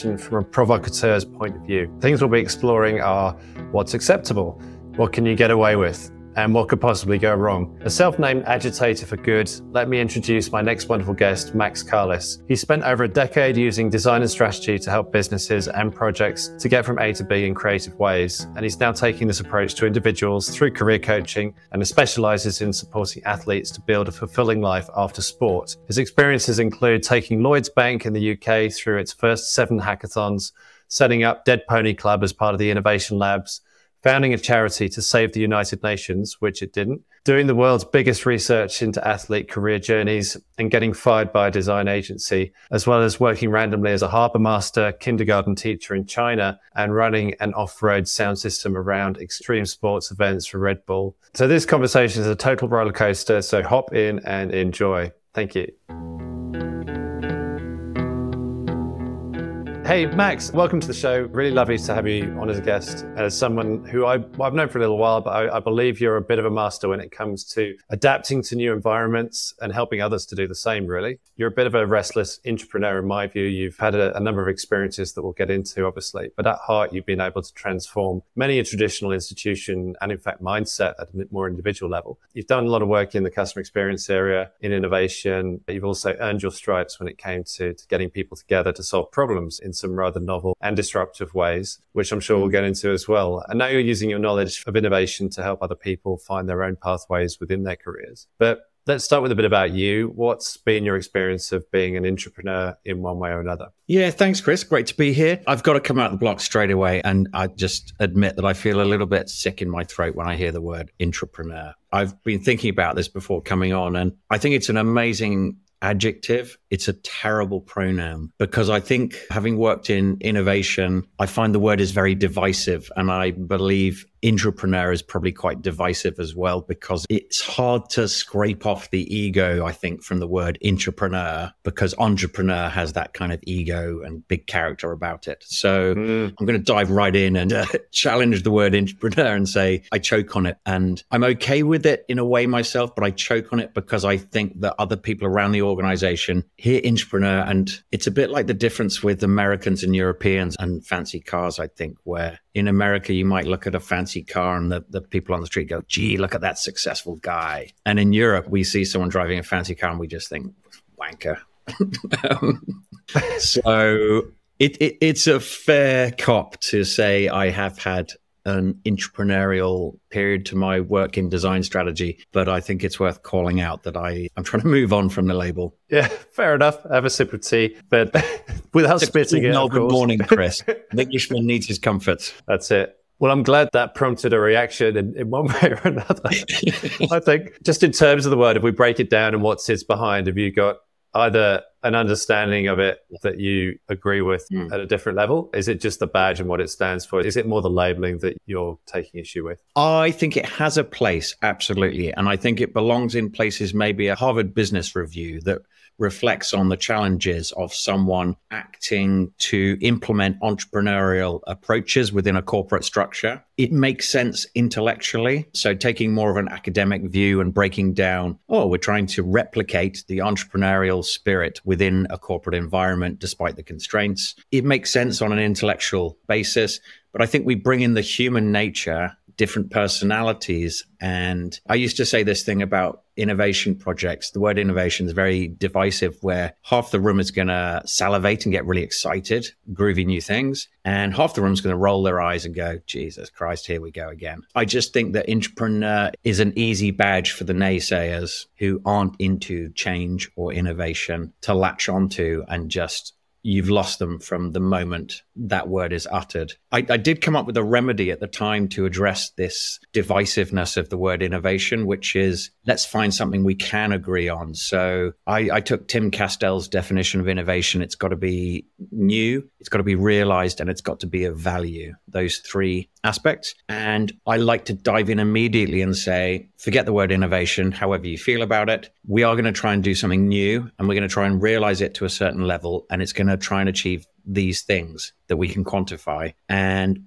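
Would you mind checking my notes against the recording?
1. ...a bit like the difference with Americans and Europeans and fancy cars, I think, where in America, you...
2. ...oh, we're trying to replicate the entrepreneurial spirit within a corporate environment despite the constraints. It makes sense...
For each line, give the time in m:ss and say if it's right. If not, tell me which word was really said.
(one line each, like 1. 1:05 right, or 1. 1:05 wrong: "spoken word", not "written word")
1. 2:28 right
2. 3:38 right.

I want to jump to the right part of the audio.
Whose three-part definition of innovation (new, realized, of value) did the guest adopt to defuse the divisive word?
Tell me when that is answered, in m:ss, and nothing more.
4:25.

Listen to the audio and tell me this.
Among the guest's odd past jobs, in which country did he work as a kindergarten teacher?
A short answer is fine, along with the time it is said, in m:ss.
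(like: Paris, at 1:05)
China, at 0:46.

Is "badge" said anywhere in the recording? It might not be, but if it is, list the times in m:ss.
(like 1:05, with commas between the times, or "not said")
3:16, 4:06.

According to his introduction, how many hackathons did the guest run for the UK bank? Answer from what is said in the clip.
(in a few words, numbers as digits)
7.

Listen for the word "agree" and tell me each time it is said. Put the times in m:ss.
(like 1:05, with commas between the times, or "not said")
3:13, 4:23.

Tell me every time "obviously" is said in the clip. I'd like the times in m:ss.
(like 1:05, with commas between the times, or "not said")
1:15.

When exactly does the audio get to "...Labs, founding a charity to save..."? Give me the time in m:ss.
0:33.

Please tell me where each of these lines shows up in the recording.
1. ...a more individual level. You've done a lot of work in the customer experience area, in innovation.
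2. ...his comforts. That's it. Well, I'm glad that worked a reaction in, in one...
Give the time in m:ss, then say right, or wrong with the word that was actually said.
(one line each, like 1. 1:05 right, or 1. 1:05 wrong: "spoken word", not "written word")
1. 1:21 right
2. 3:01 wrong: "prompted", not "worked".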